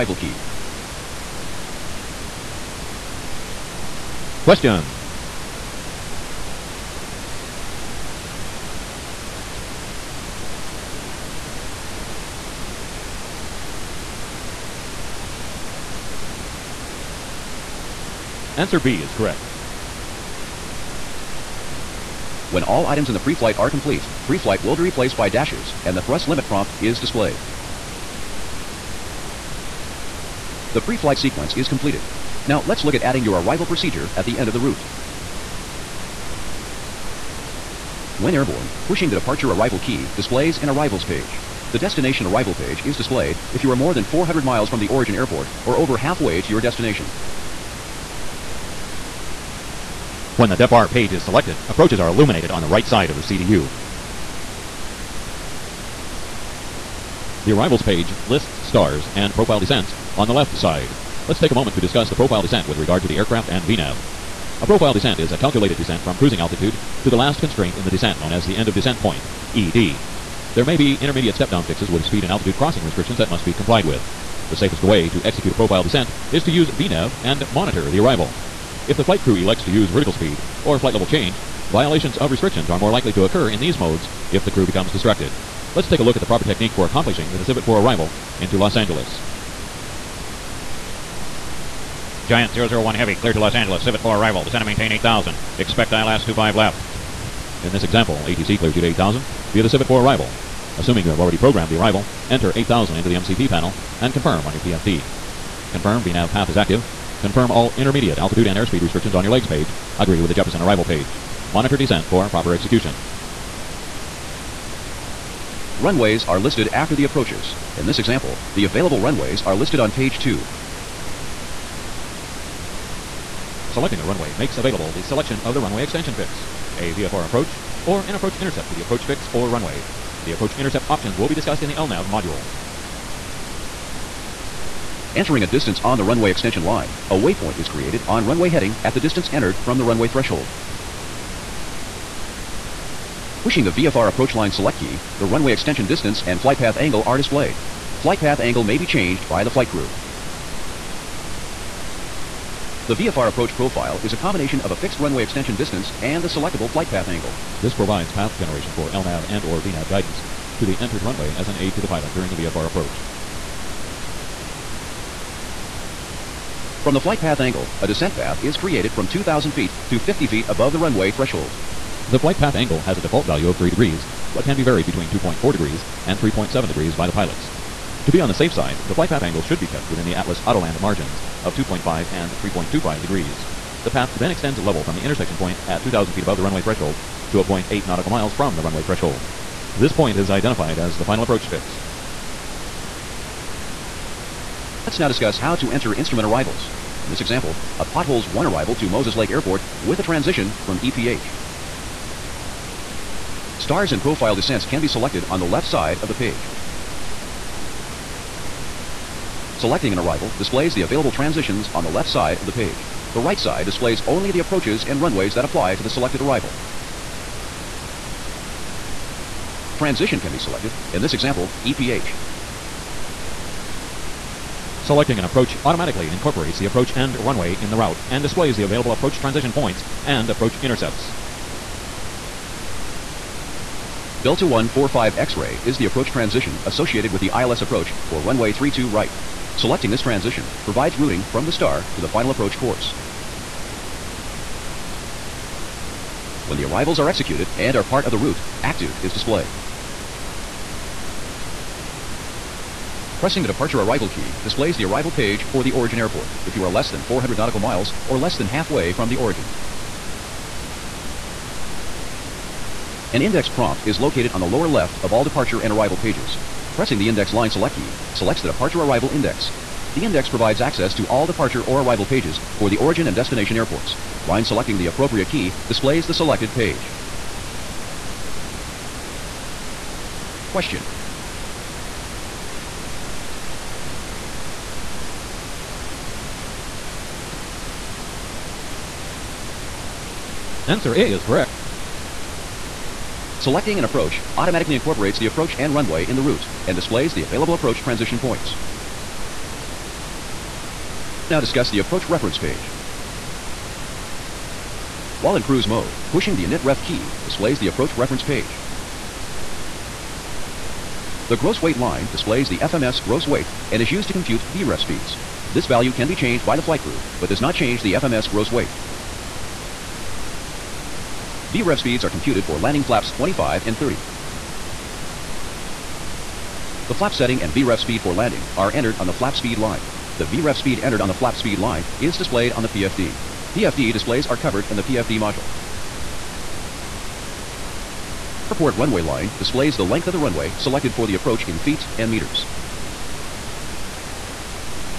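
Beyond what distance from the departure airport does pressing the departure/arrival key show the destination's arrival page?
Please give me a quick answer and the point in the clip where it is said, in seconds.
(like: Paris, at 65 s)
400 miles, at 44 s.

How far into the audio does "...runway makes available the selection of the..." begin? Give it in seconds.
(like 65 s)
124 s.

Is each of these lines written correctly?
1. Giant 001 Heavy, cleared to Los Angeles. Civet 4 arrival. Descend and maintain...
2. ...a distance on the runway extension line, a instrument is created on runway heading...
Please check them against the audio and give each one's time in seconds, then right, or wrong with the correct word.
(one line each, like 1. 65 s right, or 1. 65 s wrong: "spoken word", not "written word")
1. 92 s right
2. 135 s wrong: "waypoint", not "instrument".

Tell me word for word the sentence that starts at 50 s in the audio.
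When the DEPAR page is selected, approaches are illuminated on the right side of the CDU.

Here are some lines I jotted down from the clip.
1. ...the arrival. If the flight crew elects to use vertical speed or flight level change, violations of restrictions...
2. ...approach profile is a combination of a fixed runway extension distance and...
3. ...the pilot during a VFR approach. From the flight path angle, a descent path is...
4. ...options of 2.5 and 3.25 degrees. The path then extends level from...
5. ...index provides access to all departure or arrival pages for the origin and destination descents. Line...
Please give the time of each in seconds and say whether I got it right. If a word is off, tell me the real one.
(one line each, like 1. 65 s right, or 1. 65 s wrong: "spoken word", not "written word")
1. 77 s right
2. 153 s right
3. 161 s right
4. 180 s wrong: "margins", not "options"
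5. 270 s wrong: "airports", not "descents".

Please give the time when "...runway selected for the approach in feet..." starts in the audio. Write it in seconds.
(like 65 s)
340 s.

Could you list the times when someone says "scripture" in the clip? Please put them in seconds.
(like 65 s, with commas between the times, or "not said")
not said.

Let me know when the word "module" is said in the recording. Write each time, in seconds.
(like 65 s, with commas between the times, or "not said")
132 s, 335 s.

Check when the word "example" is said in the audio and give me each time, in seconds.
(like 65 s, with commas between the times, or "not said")
97 s, 117 s, 197 s, 221 s.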